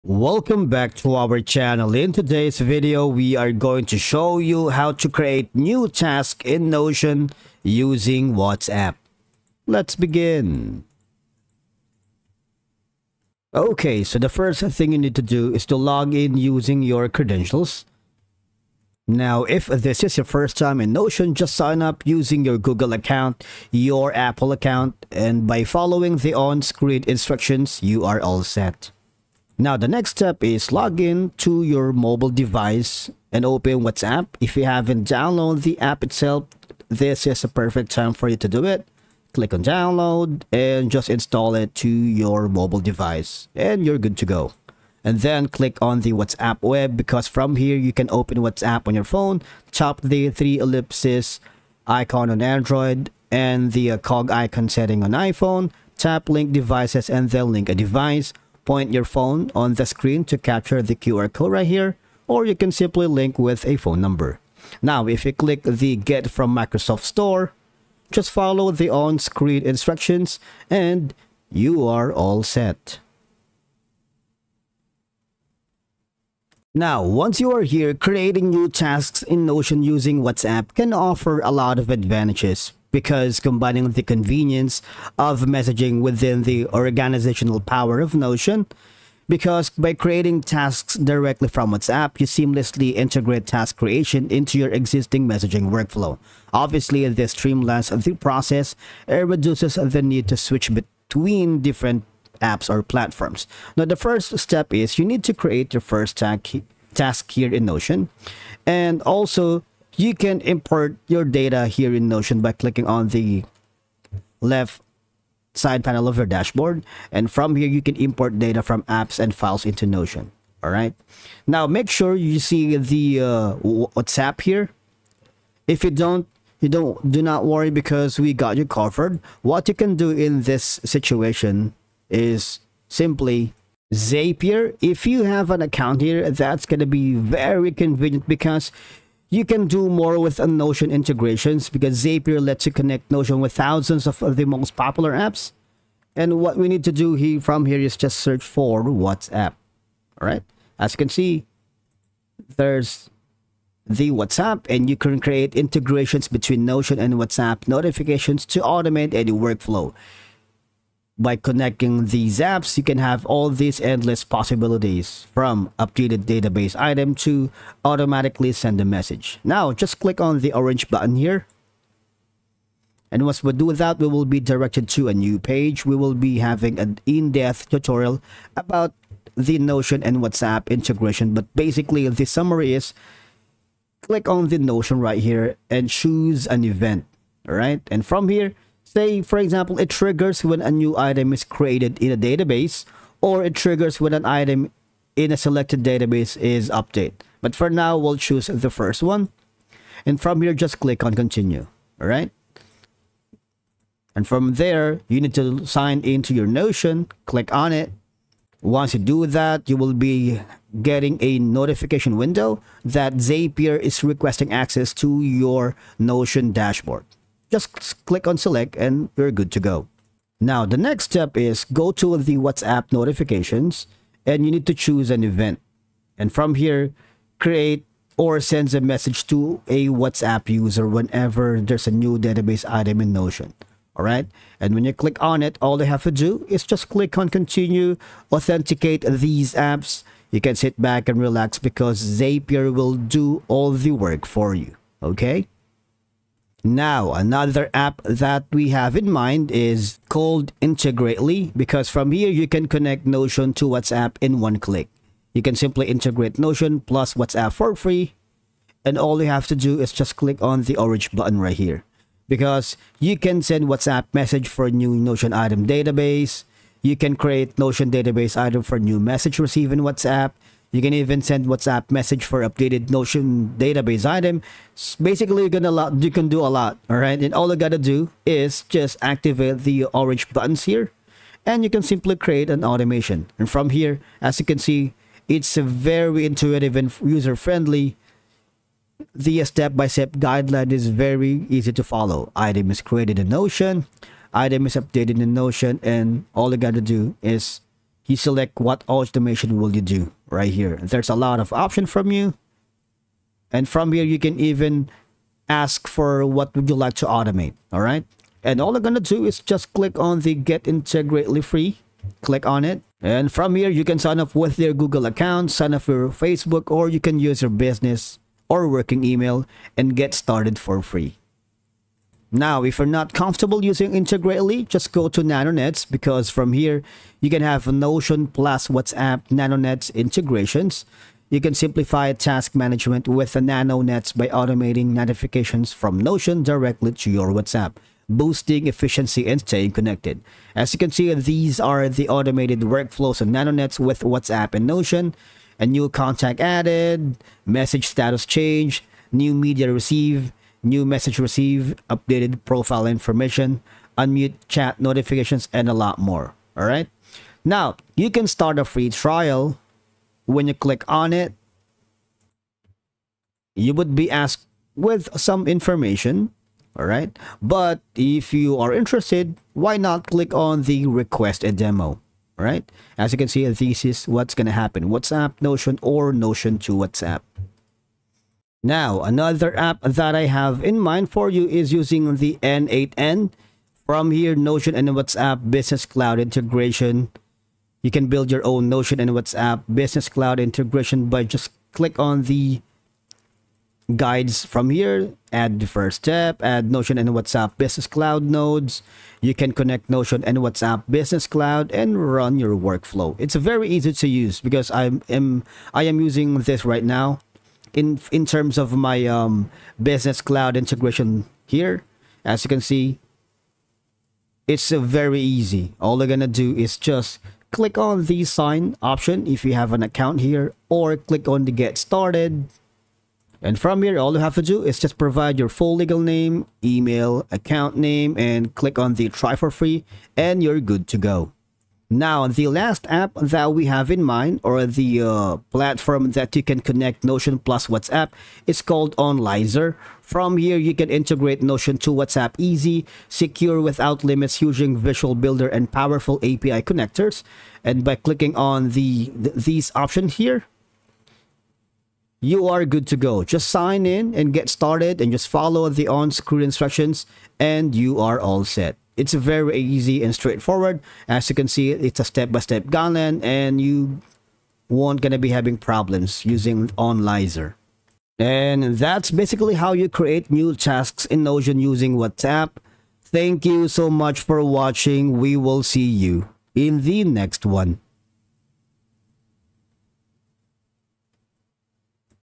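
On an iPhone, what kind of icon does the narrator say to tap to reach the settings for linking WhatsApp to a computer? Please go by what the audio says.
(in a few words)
cog icon.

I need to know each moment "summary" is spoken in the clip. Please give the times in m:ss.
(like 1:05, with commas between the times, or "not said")
3:02.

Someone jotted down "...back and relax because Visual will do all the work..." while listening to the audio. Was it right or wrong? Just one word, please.
wrong.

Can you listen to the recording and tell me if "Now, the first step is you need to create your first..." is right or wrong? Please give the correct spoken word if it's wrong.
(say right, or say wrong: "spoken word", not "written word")
right.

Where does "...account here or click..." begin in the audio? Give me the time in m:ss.
6:59.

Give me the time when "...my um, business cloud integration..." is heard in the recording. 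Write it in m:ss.
6:48.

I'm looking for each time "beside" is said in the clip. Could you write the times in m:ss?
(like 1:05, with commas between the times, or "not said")
not said.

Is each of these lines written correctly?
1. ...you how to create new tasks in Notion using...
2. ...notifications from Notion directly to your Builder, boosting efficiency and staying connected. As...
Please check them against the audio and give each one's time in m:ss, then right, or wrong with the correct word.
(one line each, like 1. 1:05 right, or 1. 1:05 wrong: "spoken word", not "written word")
1. 0:04 right
2. 5:34 wrong: "WhatsApp", not "Builder".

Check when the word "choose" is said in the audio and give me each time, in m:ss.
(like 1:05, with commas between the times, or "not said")
3:05, 3:18, 3:44.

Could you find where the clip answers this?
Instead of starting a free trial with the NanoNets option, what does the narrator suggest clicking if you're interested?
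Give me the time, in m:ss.
6:10.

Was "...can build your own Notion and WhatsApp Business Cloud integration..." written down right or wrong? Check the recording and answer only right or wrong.
right.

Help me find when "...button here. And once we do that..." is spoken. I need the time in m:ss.
2:50.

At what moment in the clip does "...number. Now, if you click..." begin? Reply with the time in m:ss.
1:04.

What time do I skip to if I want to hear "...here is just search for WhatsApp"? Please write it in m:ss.
2:27.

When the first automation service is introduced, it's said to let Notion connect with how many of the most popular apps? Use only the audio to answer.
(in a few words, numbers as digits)
thousands.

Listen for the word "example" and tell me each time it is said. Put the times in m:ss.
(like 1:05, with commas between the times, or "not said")
3:09.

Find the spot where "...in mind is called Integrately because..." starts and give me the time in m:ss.
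4:08.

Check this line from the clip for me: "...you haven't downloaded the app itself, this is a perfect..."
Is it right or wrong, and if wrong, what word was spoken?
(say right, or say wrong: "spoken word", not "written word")
right.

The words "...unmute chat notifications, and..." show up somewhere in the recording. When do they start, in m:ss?
5:53.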